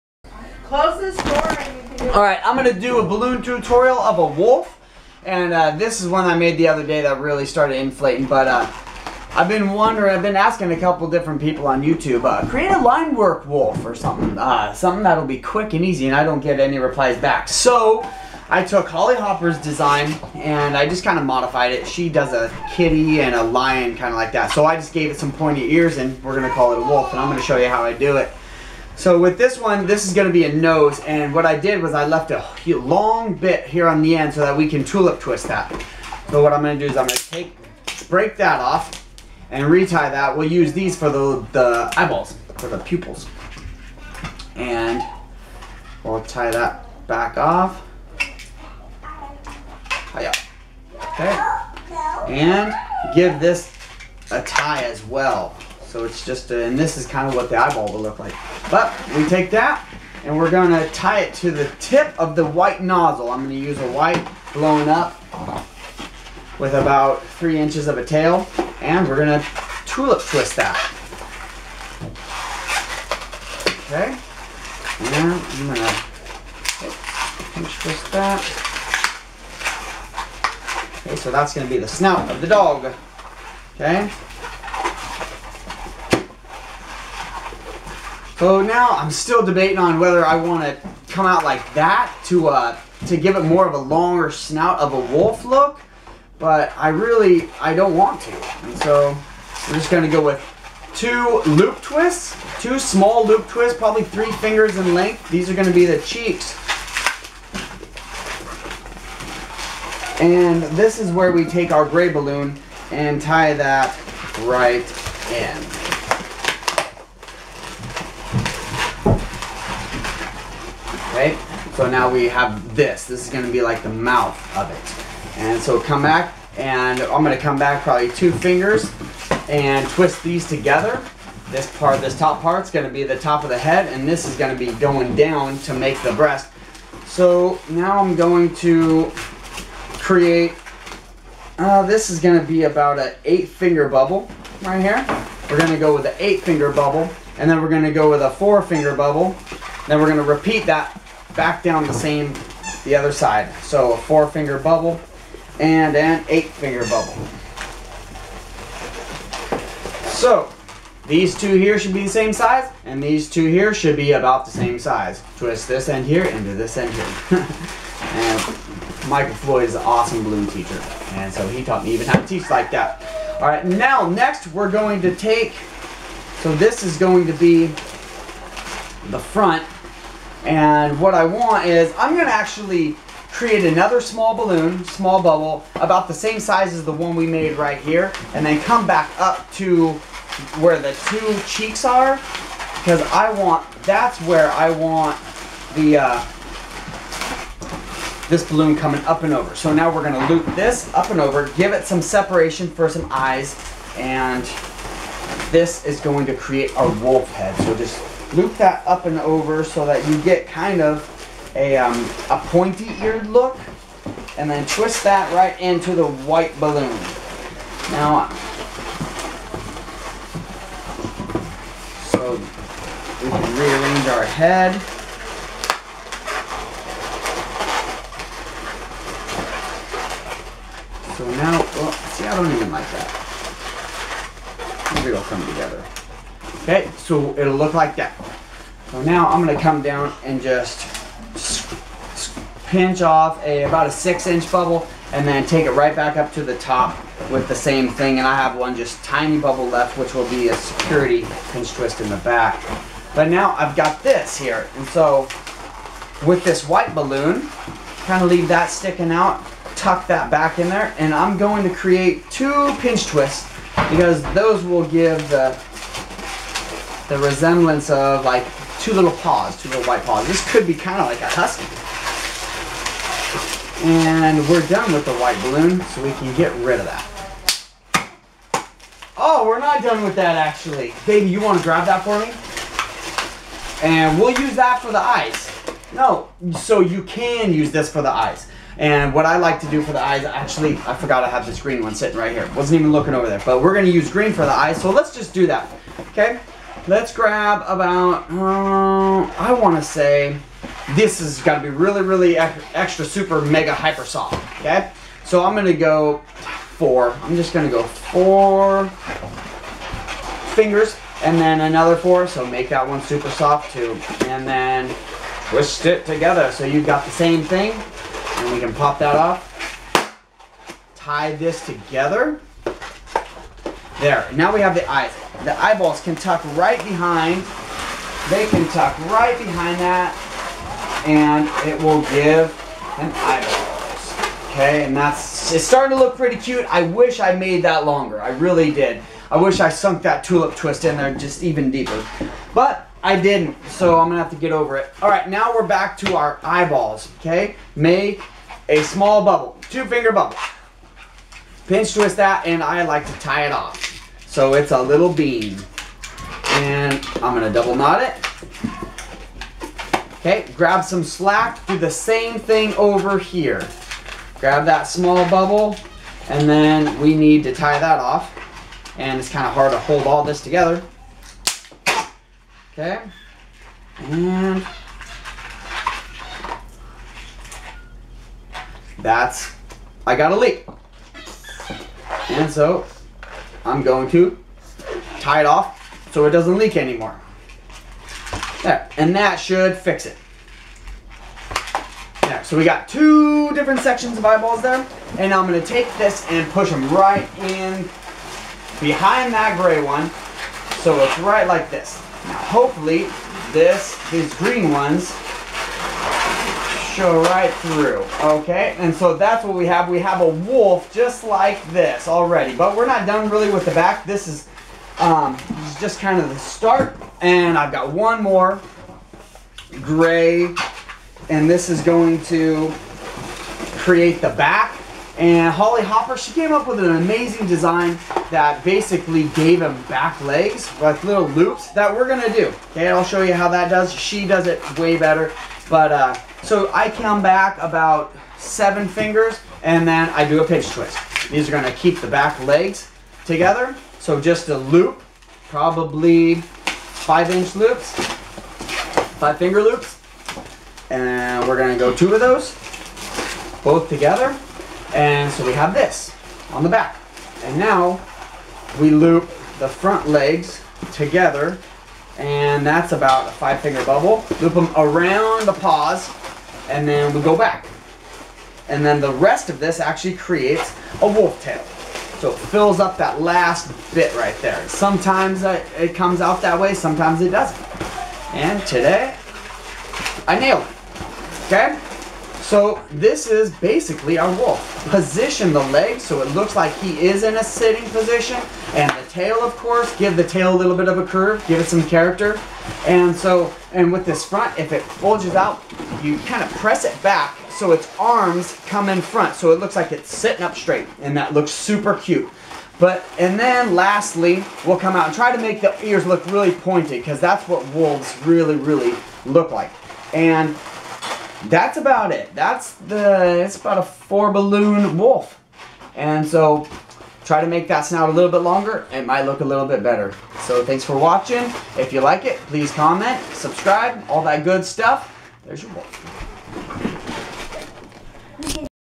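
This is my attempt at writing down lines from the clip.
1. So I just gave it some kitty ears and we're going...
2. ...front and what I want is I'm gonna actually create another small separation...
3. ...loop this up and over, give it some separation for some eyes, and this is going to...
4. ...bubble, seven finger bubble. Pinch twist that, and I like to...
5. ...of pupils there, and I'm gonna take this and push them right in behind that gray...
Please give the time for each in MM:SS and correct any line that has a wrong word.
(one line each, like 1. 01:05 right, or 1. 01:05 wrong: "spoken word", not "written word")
1. 00:24 wrong: "pointy", not "kitty"
2. 02:59 wrong: "balloon", not "separation"
3. 03:20 right
4. 05:49 wrong: "two", not "seven"
5. 06:34 wrong: "eyeballs", not "pupils".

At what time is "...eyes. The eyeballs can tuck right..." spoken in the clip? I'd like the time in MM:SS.
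05:24.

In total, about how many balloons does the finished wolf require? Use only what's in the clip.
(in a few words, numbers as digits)
4.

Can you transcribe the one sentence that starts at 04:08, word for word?
And I have one just tiny bubble left, which will be a security pinch twist in the back.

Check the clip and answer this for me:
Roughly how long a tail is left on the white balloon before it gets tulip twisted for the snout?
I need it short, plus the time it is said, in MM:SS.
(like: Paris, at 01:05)
3 inches, at 01:07.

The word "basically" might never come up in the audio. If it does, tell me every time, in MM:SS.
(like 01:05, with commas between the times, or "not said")
07:08, 08:03.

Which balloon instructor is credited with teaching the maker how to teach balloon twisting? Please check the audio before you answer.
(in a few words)
Michael Floyd.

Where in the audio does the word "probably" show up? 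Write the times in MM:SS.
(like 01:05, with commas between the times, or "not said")
01:43, 02:07, 07:25.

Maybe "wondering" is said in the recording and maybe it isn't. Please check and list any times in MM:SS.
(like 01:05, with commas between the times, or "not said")
00:09.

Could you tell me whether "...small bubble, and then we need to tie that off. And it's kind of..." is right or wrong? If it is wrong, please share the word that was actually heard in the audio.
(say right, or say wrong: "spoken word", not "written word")
right.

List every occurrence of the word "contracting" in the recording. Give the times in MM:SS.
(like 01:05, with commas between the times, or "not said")
not said.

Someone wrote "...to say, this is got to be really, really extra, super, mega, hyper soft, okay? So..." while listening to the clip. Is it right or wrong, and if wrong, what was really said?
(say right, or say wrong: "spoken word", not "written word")
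right.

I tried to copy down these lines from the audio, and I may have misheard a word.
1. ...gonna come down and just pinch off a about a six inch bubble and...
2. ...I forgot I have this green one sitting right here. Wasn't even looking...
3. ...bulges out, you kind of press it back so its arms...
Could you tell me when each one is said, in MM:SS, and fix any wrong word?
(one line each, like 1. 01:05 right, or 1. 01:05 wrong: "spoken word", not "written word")
1. 03:59 right
2. 04:50 right
3. 08:14 right.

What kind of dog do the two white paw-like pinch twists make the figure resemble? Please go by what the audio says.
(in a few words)
husky.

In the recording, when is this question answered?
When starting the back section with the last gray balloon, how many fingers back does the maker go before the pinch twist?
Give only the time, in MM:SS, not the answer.
07:18.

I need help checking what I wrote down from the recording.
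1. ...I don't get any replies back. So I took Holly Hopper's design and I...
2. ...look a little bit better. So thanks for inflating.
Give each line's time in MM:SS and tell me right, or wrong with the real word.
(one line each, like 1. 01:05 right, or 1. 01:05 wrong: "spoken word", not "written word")
1. 00:16 right
2. 08:39 wrong: "watching", not "inflating".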